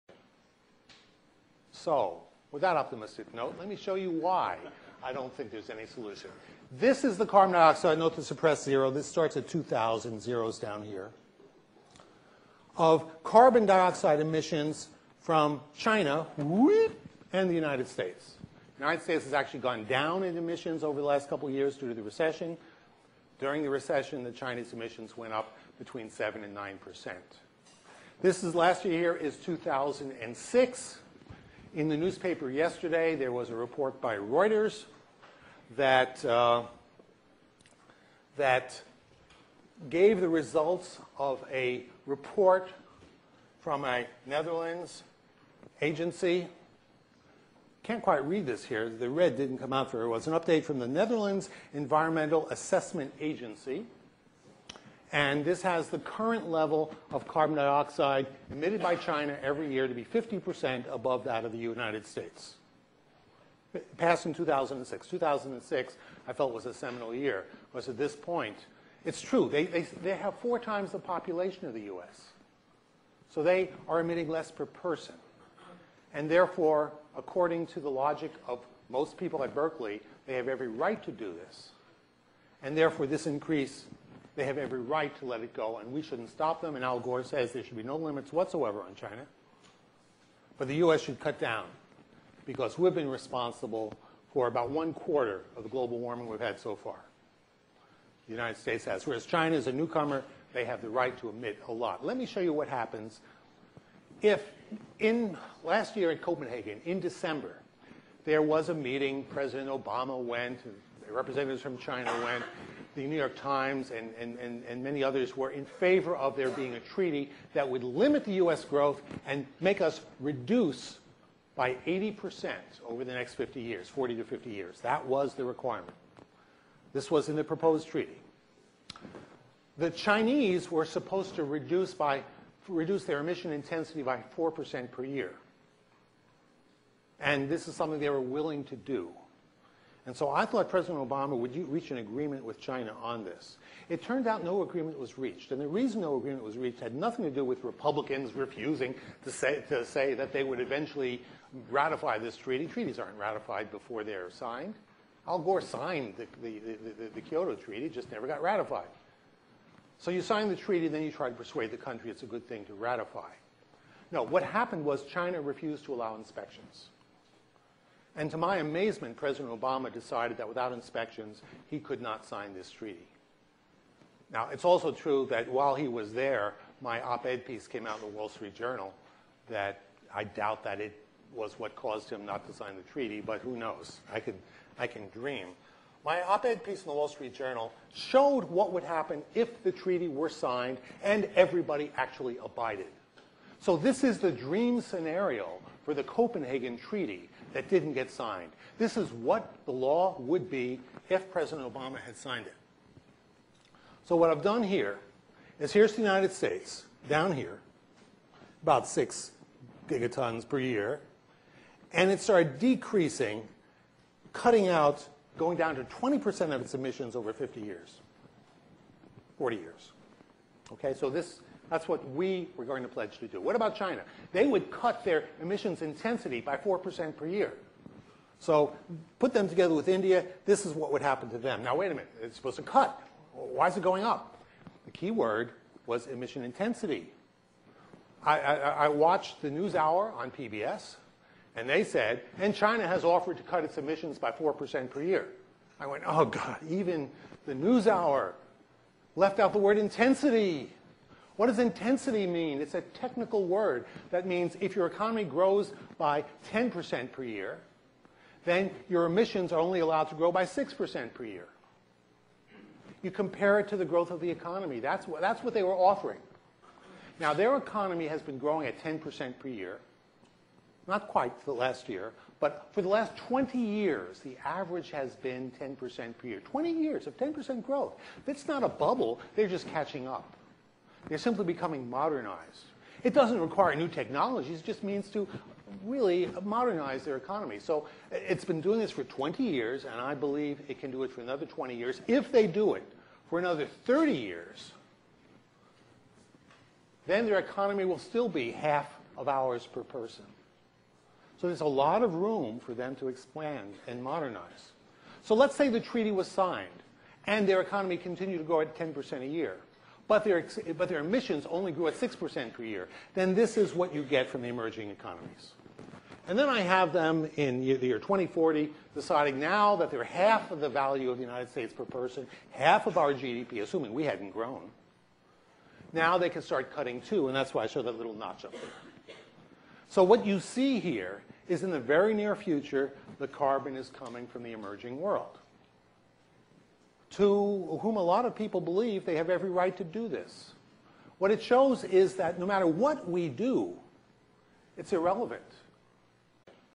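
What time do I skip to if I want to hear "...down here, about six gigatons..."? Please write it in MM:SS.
03:27.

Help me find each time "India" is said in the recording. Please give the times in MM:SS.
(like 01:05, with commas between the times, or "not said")
03:49.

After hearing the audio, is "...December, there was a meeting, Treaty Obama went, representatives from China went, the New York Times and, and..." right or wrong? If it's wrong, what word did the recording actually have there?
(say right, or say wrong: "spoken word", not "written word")
wrong: "President", not "Treaty".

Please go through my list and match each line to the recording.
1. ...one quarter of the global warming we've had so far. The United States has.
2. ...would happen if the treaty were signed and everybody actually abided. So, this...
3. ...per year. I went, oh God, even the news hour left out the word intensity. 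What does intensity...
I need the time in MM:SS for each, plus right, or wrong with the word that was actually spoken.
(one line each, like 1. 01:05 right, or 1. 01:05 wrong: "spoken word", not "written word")
1. 01:34 right
2. 03:08 right
3. 04:04 right.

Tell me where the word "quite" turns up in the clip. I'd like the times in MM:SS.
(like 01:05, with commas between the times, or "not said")
00:48, 04:31.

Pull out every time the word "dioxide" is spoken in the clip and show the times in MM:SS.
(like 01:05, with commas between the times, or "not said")
00:07, 00:13, 00:57.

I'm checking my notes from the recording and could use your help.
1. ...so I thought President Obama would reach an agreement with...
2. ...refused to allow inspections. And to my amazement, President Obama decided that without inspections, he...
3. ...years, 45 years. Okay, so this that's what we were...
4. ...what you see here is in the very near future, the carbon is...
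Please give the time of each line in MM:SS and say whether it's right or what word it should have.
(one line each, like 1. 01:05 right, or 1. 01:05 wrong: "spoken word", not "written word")
1. 02:20 right
2. 02:45 right
3. 03:37 wrong: "40", not "45"
4. 05:30 right.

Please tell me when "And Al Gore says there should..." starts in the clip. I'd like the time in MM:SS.
01:26.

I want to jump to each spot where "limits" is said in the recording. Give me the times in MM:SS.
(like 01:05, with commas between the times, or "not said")
01:27, 01:57.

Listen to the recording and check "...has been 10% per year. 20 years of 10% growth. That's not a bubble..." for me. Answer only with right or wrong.
right.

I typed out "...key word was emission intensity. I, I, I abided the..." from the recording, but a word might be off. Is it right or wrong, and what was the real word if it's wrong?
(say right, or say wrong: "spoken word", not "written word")
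wrong: "watched", not "abided".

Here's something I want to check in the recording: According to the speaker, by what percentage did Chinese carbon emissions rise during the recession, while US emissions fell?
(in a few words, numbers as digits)
7 to 9 percent.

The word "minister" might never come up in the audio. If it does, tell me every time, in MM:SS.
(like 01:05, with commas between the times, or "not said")
not said.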